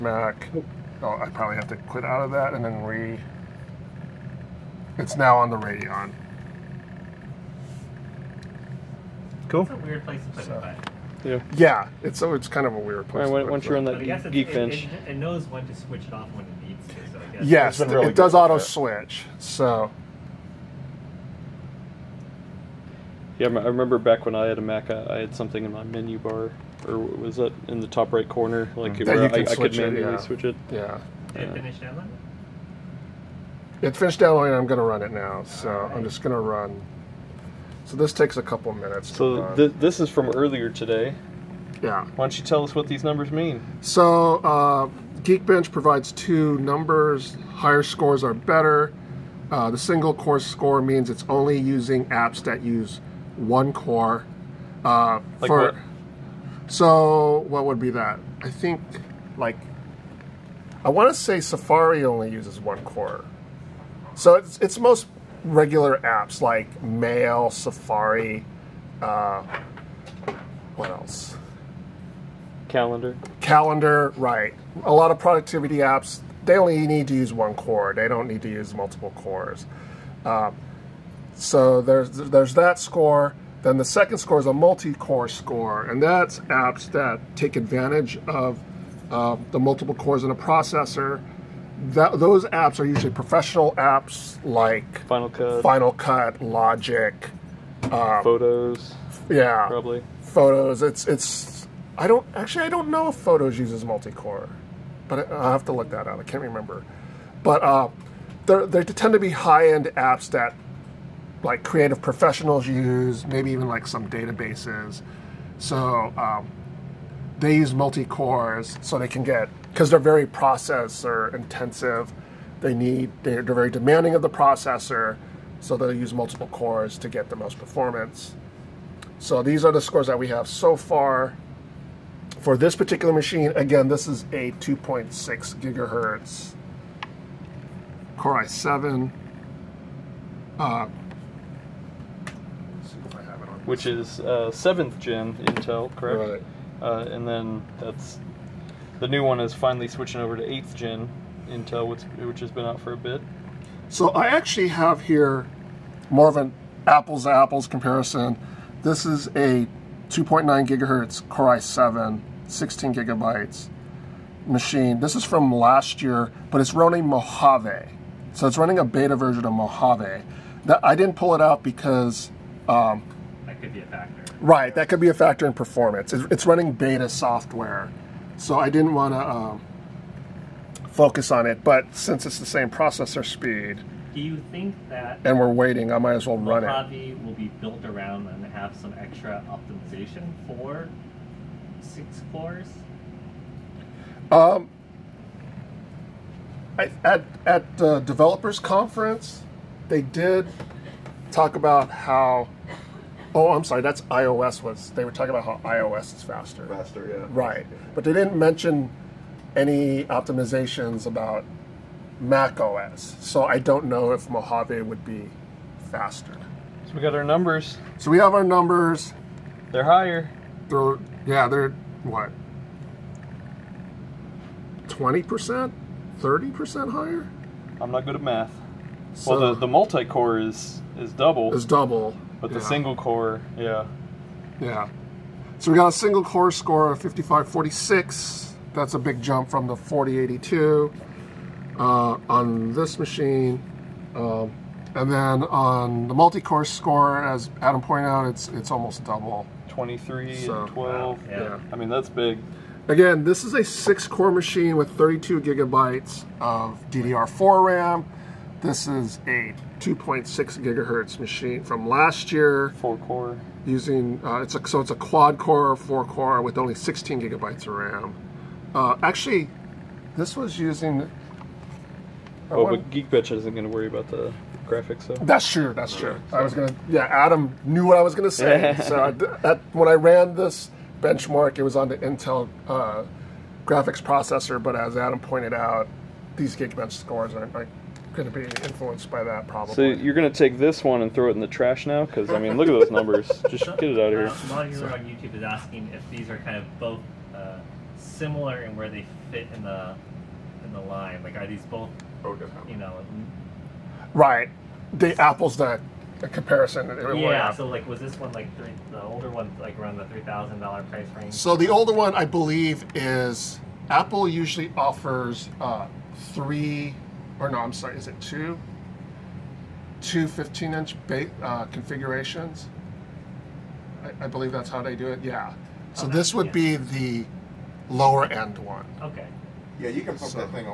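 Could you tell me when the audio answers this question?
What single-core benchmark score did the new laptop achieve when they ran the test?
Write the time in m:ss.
3:57.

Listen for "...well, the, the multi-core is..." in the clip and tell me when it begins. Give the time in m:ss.
3:49.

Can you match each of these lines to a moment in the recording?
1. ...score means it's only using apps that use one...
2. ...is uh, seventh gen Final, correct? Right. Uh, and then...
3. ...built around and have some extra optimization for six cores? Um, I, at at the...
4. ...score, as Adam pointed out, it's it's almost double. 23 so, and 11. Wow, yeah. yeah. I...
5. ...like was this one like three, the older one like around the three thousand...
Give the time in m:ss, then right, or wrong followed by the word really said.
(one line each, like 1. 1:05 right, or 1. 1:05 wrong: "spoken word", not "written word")
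1. 0:50 right
2. 2:23 wrong: "Intel", not "Final"
3. 3:07 right
4. 4:06 wrong: "12", not "11"
5. 5:07 right.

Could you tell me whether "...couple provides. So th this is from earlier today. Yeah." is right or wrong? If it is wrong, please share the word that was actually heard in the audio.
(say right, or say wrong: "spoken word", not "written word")
wrong: "minutes", not "provides".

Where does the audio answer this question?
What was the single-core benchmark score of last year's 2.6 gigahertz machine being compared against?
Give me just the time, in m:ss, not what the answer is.
3:59.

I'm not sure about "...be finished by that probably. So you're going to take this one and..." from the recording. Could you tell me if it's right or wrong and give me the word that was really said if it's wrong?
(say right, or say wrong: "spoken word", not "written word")
wrong: "influenced", not "finished".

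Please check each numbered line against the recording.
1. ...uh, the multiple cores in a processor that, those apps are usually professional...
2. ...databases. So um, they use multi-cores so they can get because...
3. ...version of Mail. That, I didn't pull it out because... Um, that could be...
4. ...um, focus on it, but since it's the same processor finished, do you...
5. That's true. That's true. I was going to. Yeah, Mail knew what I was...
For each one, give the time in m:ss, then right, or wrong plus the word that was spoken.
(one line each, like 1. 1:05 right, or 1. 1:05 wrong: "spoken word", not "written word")
1. 1:29 right
2. 1:54 right
3. 2:49 wrong: "Mojave", not "Mail"
4. 2:59 wrong: "speed", not "finished"
5. 4:35 wrong: "Adam", not "Mail".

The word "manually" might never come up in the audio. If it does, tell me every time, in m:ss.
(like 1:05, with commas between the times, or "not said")
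0:29.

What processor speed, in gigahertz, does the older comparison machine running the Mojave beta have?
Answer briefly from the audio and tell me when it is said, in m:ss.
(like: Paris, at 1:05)
2.9 gigahertz, at 2:40.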